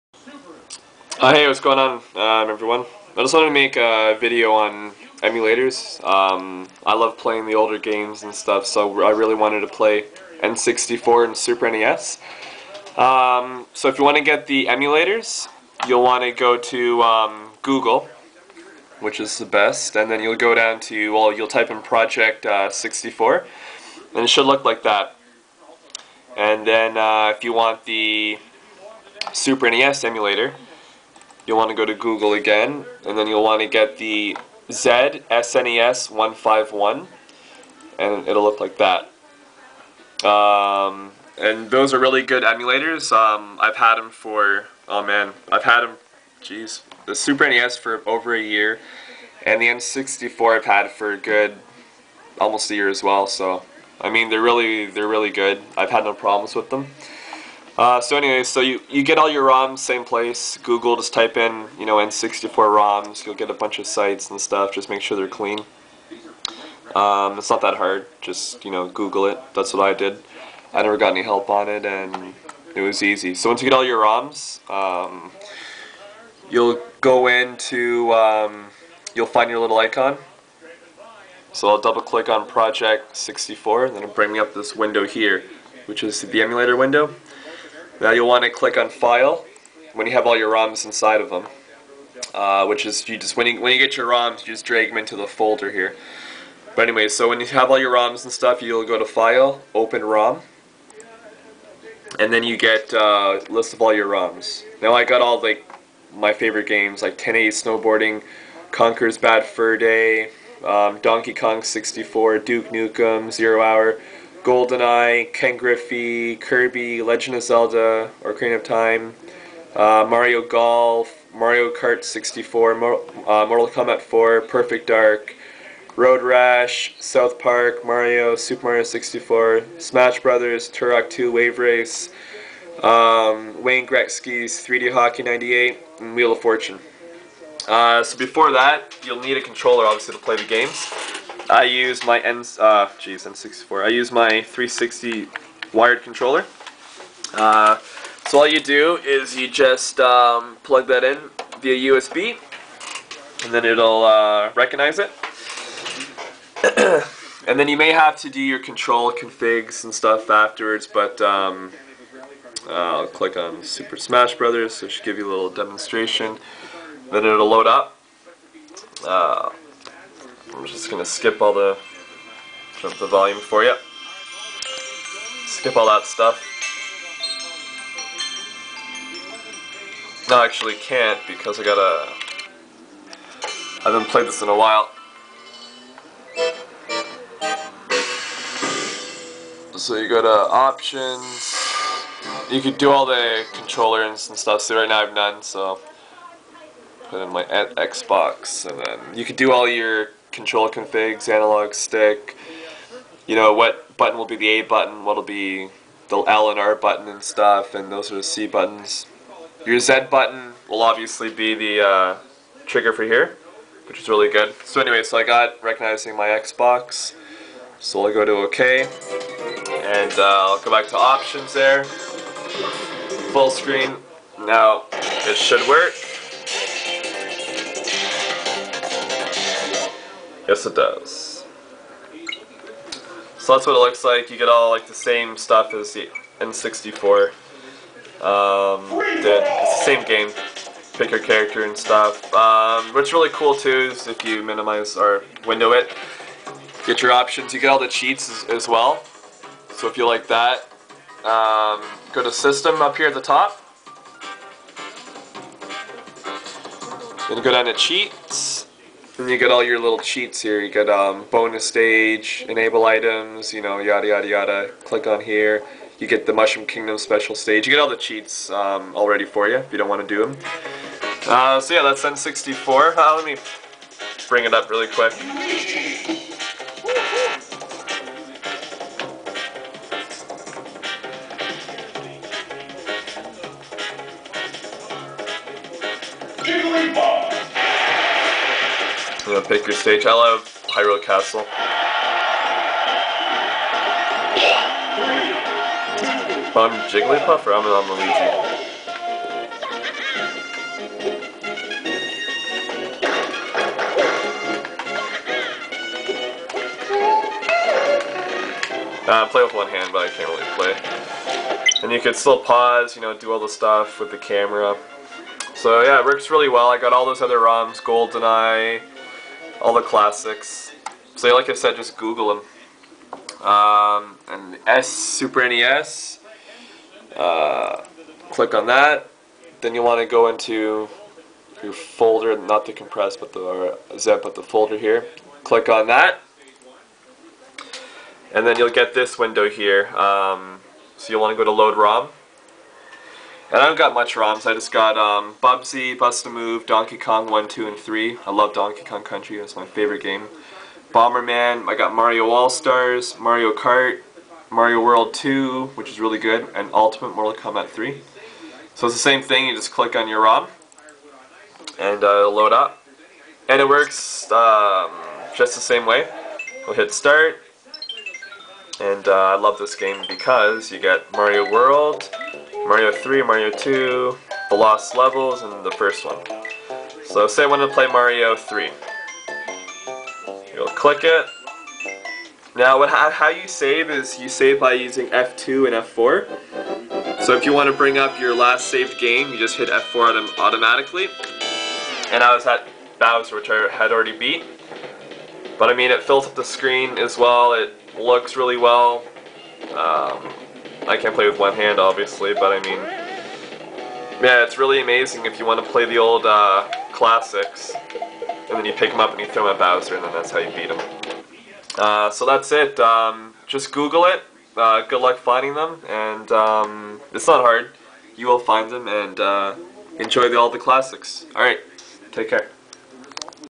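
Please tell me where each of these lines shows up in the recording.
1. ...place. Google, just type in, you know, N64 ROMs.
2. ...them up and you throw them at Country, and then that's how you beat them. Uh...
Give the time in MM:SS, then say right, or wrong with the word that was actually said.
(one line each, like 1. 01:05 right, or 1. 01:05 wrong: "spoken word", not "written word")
1. 01:00 right
2. 06:48 wrong: "Bowser", not "Country".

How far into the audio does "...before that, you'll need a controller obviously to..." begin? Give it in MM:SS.
02:18.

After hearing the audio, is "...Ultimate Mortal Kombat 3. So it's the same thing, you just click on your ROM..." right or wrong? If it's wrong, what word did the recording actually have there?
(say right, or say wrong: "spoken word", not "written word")
right.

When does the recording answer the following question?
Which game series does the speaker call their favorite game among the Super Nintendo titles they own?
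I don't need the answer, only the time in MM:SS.
05:48.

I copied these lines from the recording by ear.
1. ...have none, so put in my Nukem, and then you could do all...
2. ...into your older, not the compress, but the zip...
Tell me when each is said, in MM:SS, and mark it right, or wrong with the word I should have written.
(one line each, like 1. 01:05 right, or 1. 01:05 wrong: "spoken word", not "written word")
1. 03:15 wrong: "Xbox", not "Nukem"
2. 05:30 wrong: "folder", not "older".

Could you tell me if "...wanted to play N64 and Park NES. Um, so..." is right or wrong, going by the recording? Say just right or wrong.
wrong.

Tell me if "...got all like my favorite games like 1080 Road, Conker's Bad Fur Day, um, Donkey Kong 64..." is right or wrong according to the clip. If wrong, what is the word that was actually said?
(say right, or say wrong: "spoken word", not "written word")
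wrong: "Snowboarding", not "Road".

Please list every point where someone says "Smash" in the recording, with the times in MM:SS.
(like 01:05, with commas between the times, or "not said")
02:09, 02:43.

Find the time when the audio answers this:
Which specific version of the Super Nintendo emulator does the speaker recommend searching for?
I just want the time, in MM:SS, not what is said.
00:34.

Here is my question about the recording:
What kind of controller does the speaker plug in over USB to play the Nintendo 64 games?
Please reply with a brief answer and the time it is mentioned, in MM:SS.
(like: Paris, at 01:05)
360 wired controller, at 02:24.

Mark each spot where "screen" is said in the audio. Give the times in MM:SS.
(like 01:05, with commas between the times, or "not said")
03:43, 06:36.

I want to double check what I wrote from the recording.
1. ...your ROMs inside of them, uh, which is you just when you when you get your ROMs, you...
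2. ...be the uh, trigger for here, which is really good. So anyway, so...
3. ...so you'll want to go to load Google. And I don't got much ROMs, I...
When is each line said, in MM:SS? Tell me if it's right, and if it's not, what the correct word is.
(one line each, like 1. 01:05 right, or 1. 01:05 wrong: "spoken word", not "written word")
1. 01:30 right
2. 03:31 right
3. 05:40 wrong: "ROM", not "Google".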